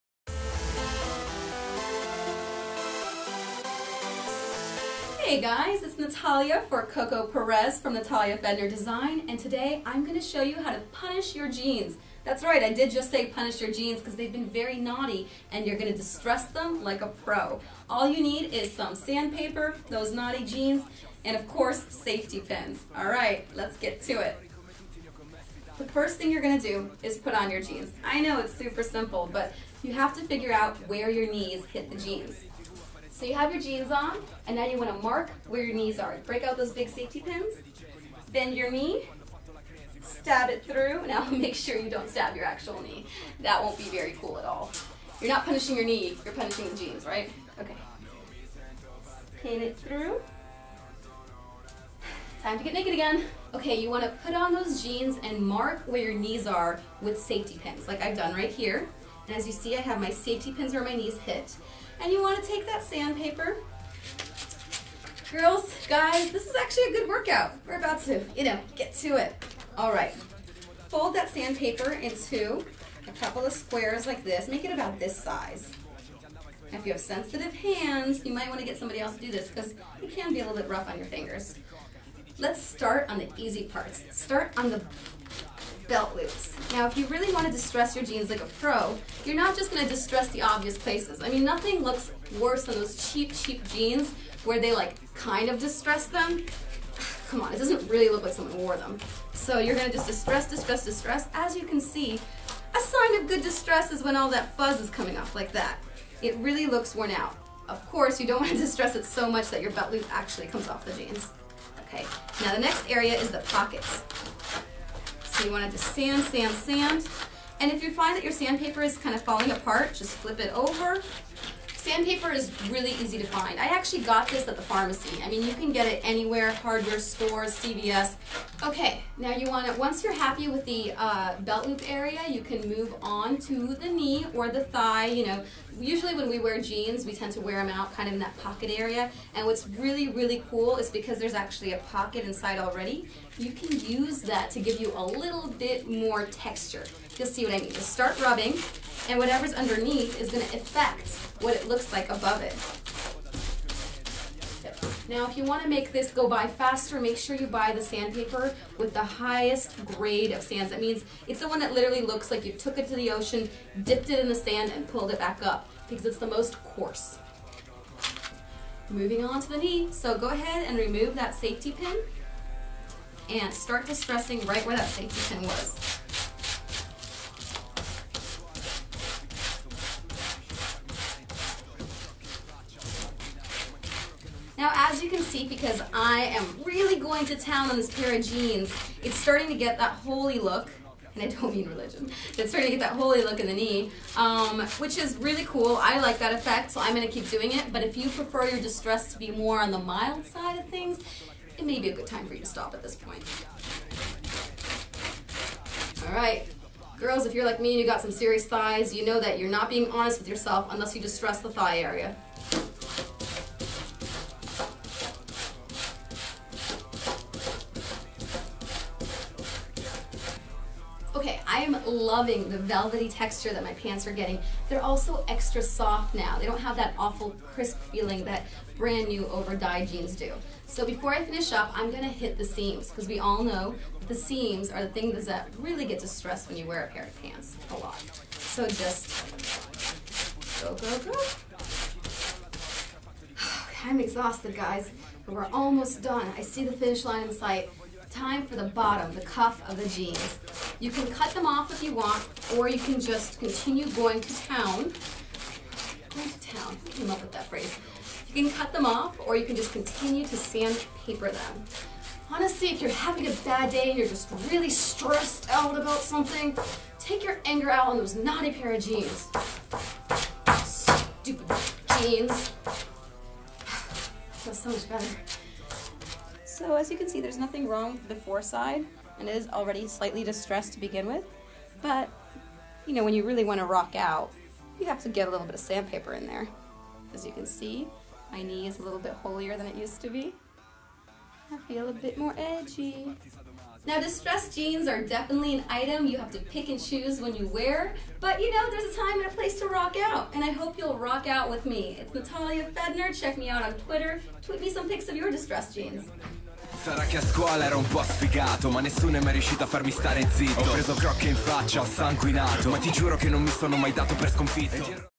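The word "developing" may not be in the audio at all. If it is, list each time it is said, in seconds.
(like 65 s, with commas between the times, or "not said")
not said.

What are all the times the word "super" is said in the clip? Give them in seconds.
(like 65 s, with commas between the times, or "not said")
28 s.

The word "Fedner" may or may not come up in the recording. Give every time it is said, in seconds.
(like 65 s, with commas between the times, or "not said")
8 s, 302 s.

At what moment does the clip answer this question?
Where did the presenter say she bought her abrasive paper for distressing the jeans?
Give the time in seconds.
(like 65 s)
124 s.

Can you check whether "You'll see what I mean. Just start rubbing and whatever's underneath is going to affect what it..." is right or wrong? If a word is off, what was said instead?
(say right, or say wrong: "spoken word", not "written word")
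right.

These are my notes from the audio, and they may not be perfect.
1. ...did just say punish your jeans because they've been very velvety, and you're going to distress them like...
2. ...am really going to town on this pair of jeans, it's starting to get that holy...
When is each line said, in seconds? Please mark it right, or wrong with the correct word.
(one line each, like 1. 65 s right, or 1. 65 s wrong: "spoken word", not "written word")
1. 12 s wrong: "naughty", not "velvety"
2. 186 s right.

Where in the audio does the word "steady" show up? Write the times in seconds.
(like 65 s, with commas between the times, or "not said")
not said.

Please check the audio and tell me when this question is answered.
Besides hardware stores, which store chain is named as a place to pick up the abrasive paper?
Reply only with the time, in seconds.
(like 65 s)
127 s.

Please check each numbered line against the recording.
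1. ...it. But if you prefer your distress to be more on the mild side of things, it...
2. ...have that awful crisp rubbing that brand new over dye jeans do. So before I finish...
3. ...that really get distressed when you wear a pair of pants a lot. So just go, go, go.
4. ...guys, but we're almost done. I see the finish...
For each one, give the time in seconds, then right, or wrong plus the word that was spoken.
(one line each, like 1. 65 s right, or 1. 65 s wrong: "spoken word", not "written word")
1. 197 s right
2. 226 s wrong: "feeling", not "rubbing"
3. 235 s right
4. 244 s right.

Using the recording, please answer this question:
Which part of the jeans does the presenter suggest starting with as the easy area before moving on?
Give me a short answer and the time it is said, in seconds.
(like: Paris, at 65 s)
Belt loops, at 85 s.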